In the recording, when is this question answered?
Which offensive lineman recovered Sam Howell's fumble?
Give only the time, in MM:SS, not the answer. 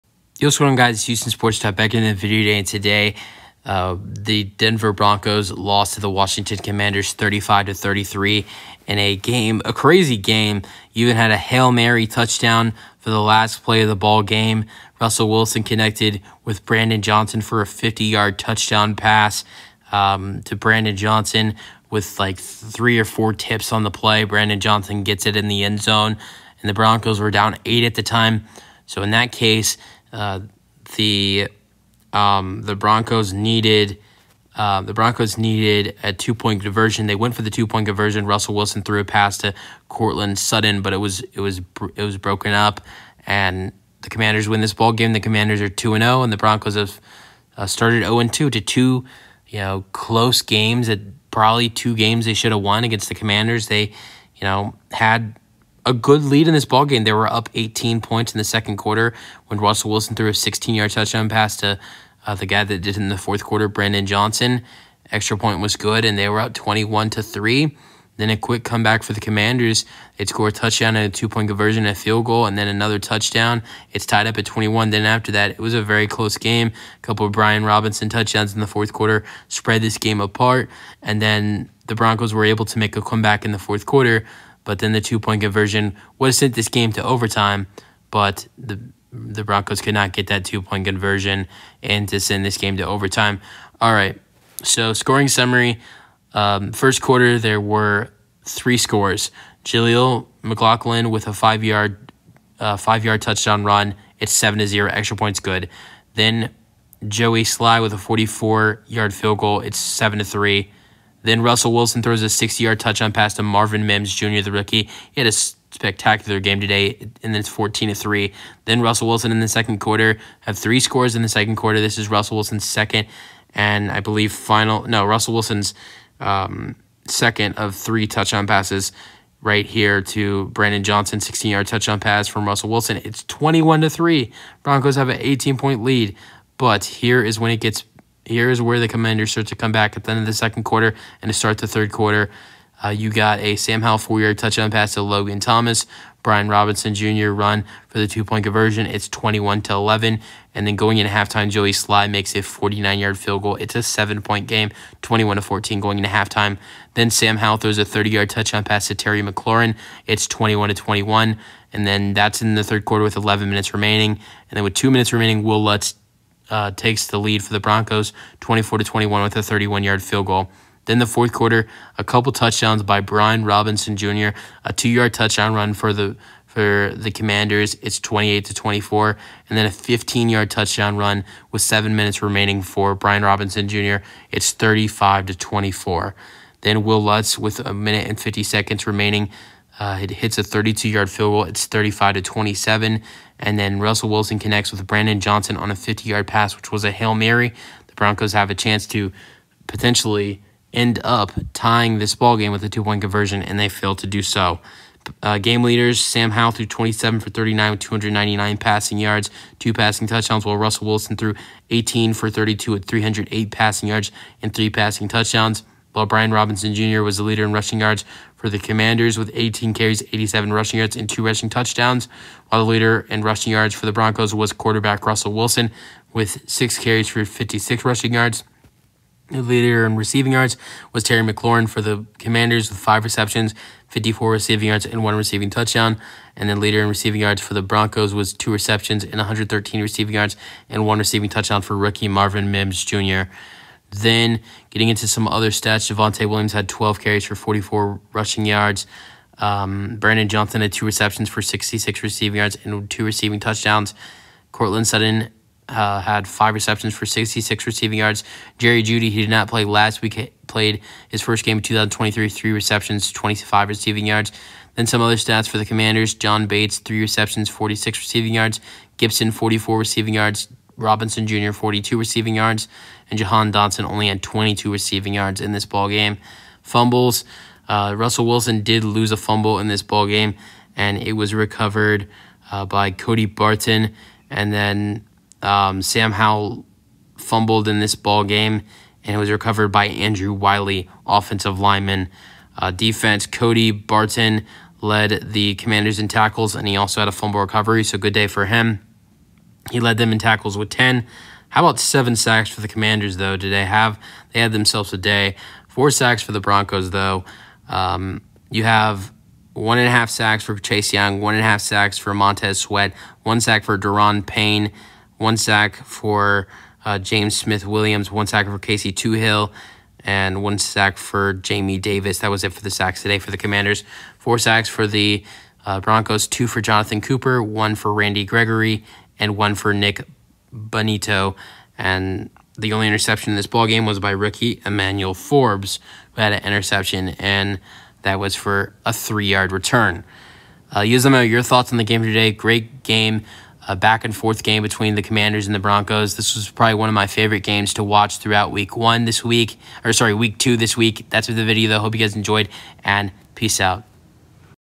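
04:49.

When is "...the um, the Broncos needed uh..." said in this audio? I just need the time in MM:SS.
00:30.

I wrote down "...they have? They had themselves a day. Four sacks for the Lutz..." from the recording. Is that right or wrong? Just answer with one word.
wrong.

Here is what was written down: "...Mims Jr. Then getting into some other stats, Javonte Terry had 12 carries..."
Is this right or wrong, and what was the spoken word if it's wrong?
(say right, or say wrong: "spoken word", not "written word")
wrong: "Williams", not "Terry".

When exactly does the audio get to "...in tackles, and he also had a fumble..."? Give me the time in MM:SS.
04:55.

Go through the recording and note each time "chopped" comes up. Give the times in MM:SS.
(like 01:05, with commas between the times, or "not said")
not said.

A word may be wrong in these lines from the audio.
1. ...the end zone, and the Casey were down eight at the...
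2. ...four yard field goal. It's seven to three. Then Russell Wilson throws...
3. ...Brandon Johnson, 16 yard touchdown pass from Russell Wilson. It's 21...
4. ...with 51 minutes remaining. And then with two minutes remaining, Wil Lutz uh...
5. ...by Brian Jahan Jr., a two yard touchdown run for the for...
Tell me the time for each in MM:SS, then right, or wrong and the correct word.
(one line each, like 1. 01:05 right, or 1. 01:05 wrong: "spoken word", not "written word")
1. 00:25 wrong: "Broncos", not "Casey"
2. 01:48 right
3. 02:10 right
4. 02:43 wrong: "11", not "51"
5. 02:52 wrong: "Robinson", not "Jahan".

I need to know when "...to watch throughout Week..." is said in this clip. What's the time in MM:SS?
05:47.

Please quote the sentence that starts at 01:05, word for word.
Extra point was good, and they were up 21 to three.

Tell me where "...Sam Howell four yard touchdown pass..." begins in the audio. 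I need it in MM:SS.
02:23.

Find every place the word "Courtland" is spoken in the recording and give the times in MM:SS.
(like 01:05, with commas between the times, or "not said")
00:39, 04:14.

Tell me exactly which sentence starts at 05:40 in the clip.
Uh, Yuzumo, your thoughts on the game today?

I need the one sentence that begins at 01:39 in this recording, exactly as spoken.
Jaleel McLaughlin with a five yard uh, five yard touchdown run.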